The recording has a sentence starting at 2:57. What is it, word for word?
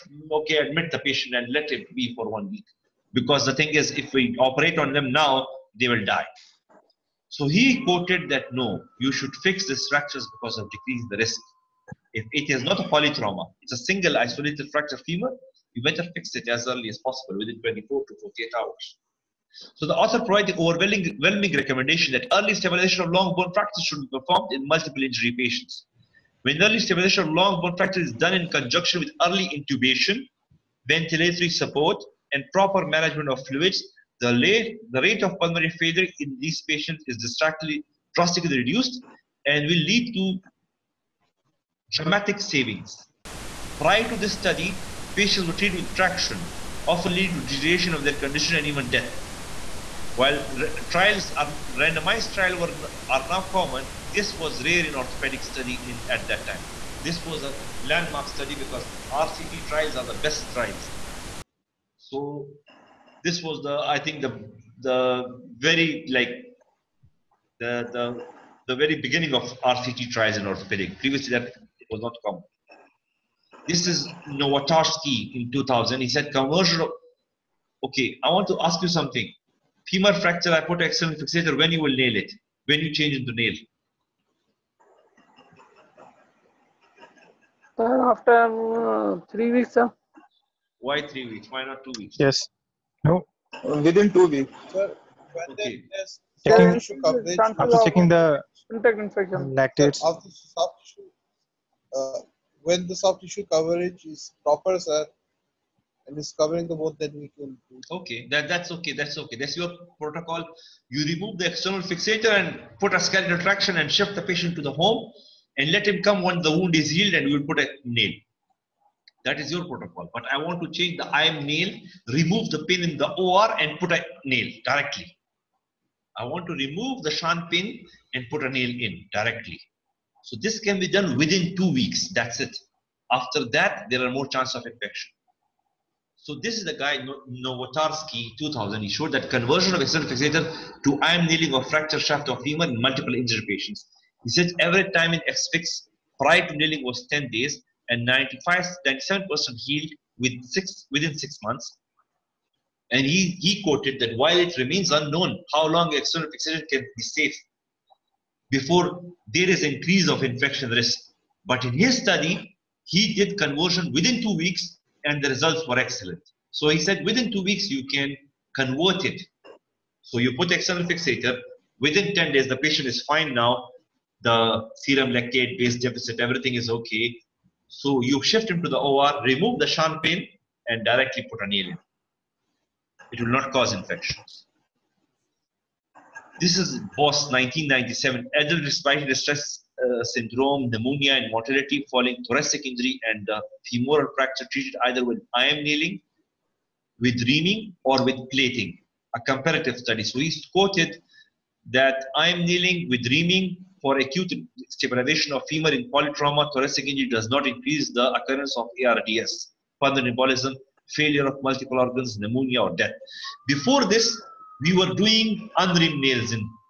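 So you shift him to the OR, remove the Schanz pin, and directly put a nail It will not cause infections.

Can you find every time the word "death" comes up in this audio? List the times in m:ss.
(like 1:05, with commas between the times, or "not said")
0:48, 3:32.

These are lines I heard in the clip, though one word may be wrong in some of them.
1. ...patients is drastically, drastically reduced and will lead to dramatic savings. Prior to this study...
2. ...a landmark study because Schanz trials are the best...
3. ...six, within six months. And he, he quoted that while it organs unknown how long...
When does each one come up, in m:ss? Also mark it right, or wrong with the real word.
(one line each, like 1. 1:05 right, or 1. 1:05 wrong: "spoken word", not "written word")
1. 0:36 right
2. 0:57 wrong: "RCT", not "Schanz"
3. 2:30 wrong: "remains", not "organs".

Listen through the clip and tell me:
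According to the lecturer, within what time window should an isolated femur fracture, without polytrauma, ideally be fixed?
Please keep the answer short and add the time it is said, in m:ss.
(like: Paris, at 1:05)
24 to 48 hours, at 0:17.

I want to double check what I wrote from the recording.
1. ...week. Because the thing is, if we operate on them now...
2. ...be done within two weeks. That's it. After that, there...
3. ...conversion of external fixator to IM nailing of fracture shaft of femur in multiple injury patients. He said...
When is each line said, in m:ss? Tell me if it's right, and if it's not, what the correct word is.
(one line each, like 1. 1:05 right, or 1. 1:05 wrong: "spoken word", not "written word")
1. 0:02 right
2. 2:10 right
3. 2:19 right.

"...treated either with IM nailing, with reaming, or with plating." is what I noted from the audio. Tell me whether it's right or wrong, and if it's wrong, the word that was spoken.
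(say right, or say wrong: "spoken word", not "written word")
right.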